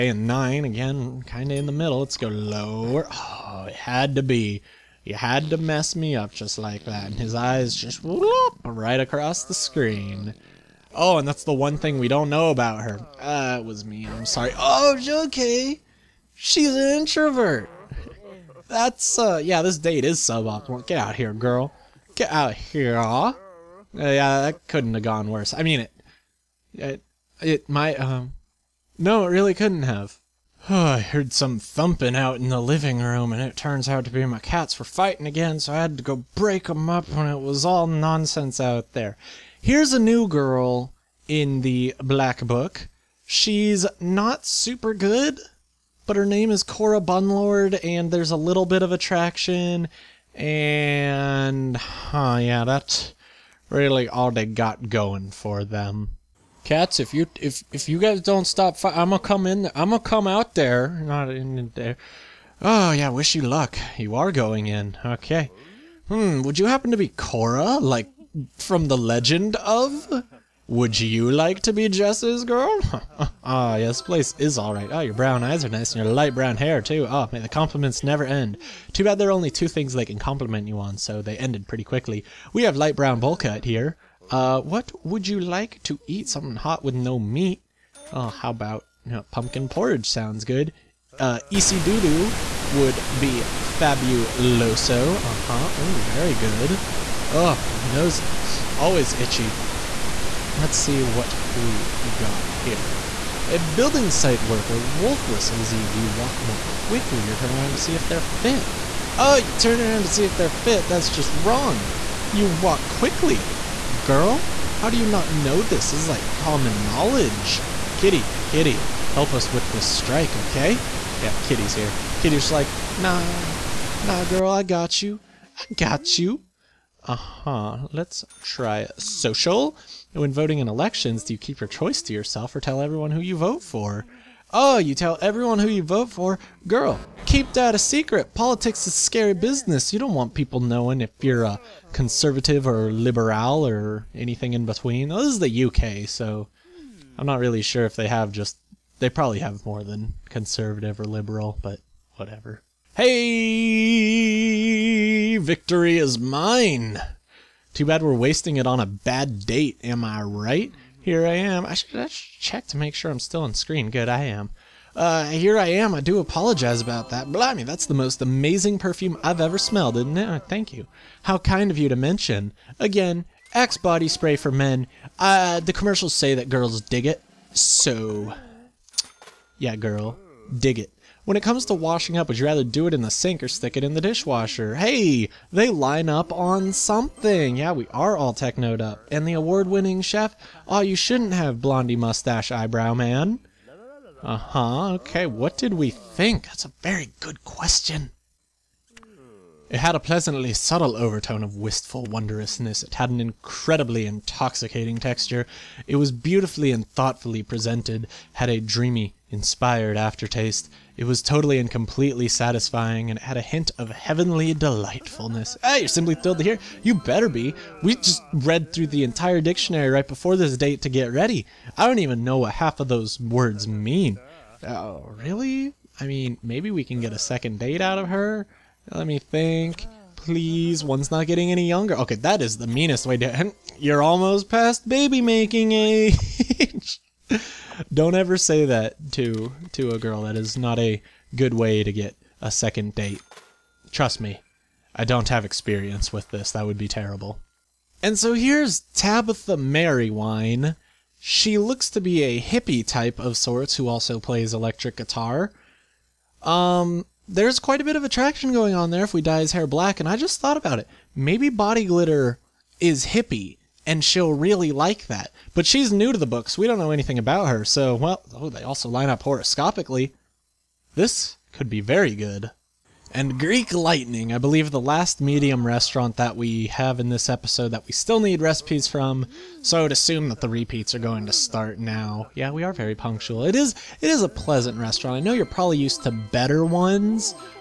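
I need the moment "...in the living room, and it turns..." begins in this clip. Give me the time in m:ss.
0:32.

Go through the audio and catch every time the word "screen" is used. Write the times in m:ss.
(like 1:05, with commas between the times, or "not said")
0:09, 2:43.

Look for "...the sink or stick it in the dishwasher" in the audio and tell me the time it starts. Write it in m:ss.
3:03.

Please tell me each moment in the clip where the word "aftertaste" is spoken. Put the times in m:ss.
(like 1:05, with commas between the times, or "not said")
3:29.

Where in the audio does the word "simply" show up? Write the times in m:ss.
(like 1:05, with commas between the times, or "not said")
3:35.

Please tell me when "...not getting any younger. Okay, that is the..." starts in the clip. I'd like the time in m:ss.
3:51.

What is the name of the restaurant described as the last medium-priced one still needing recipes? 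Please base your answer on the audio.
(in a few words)
Greek Lightning.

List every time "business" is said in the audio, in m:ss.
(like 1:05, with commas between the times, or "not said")
2:19.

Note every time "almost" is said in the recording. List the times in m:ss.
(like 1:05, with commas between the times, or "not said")
3:54.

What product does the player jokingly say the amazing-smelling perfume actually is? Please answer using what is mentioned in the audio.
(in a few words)
Axe body spray.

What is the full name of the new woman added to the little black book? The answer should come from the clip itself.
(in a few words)
Cora Bunlord.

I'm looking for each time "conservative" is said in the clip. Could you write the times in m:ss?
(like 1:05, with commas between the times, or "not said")
2:21, 2:30.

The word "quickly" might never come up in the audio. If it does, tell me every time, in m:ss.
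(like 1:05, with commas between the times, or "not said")
1:21, 1:46, 1:52.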